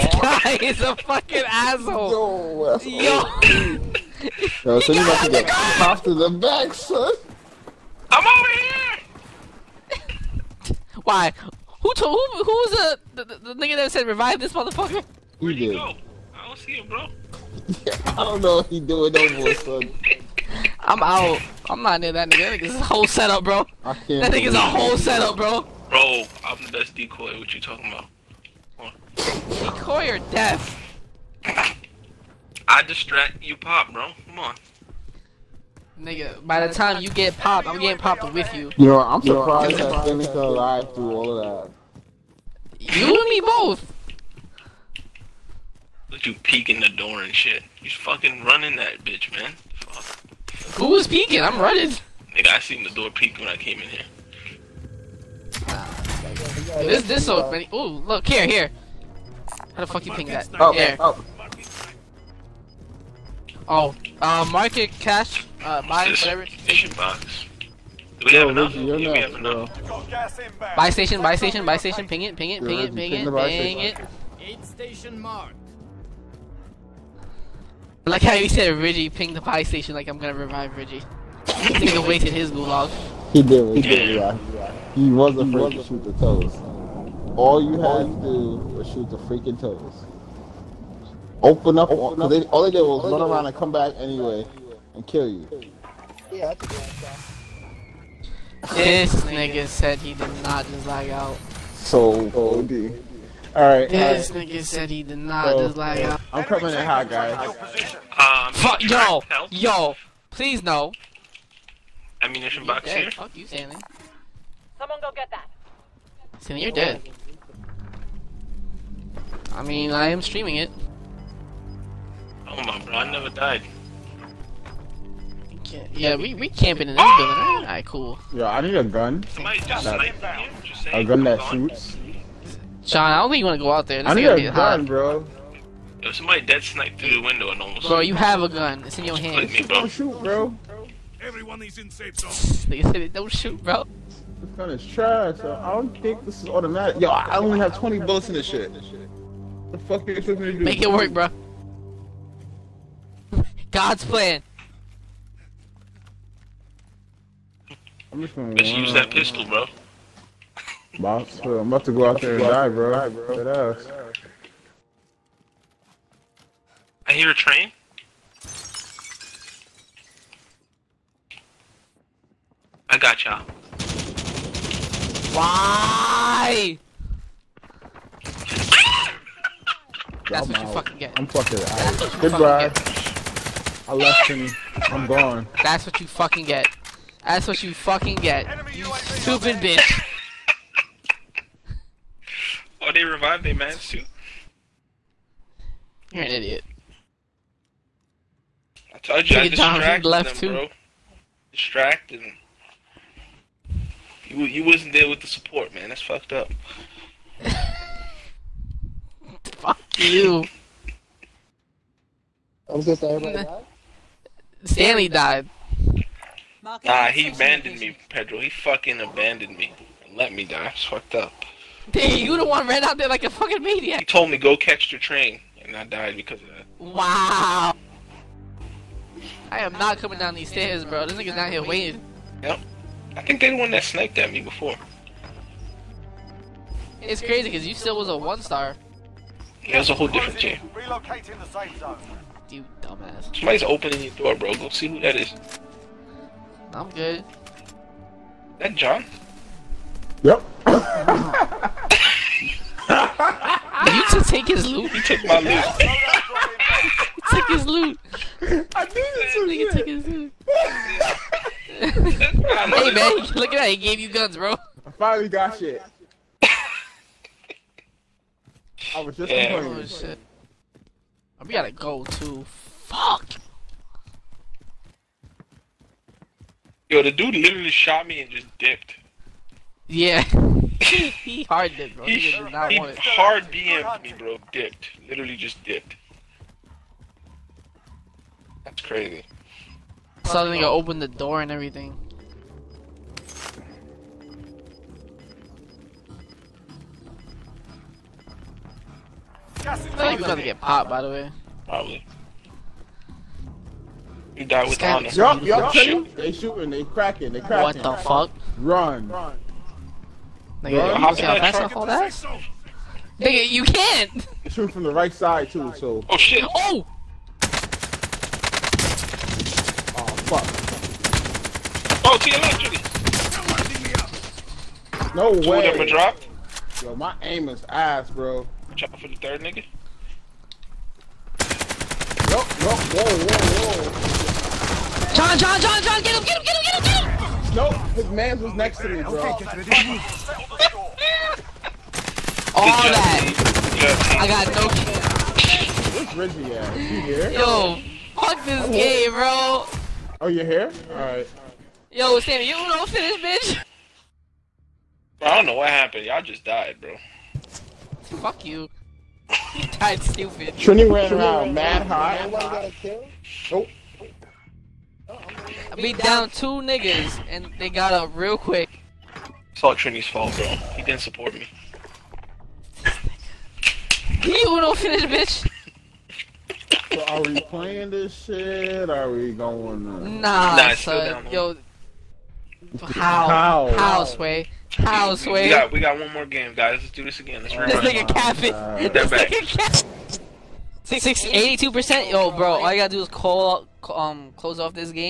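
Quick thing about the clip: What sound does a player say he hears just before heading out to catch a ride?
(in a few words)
A train.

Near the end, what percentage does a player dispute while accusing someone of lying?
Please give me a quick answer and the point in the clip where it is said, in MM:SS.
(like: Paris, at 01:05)
82%, at 06:30.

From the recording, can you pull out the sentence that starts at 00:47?
You fucking running that bitch, man.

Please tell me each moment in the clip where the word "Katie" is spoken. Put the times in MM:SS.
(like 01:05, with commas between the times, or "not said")
not said.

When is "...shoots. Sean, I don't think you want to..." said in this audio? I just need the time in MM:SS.
02:11.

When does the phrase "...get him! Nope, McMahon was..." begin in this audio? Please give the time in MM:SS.
05:36.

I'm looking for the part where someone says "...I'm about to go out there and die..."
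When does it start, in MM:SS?
02:41.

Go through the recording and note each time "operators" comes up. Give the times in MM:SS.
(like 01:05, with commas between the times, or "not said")
not said.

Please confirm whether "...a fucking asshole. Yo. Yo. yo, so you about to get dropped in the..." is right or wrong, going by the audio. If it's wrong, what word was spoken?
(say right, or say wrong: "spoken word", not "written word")
wrong: "popped", not "dropped".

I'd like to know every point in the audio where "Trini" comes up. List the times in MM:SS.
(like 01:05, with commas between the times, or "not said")
06:00, 06:09.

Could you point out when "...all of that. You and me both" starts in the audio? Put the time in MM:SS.
00:41.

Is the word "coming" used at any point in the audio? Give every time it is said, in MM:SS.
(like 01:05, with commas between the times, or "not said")
01:46, 03:49.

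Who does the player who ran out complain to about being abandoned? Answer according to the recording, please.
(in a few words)
Pedro.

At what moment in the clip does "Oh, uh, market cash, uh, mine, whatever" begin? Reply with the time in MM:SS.
01:03.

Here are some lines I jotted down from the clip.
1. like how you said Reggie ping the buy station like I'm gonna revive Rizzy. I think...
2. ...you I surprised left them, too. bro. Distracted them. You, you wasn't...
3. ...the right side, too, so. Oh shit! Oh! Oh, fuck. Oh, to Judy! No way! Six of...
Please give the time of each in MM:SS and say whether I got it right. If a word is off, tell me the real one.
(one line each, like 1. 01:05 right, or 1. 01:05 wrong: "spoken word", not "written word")
1. 01:18 wrong: "Reggie", not "Rizzy"
2. 03:19 wrong: "distracted", not "surprised"
3. 05:14 wrong: "Two", not "Six".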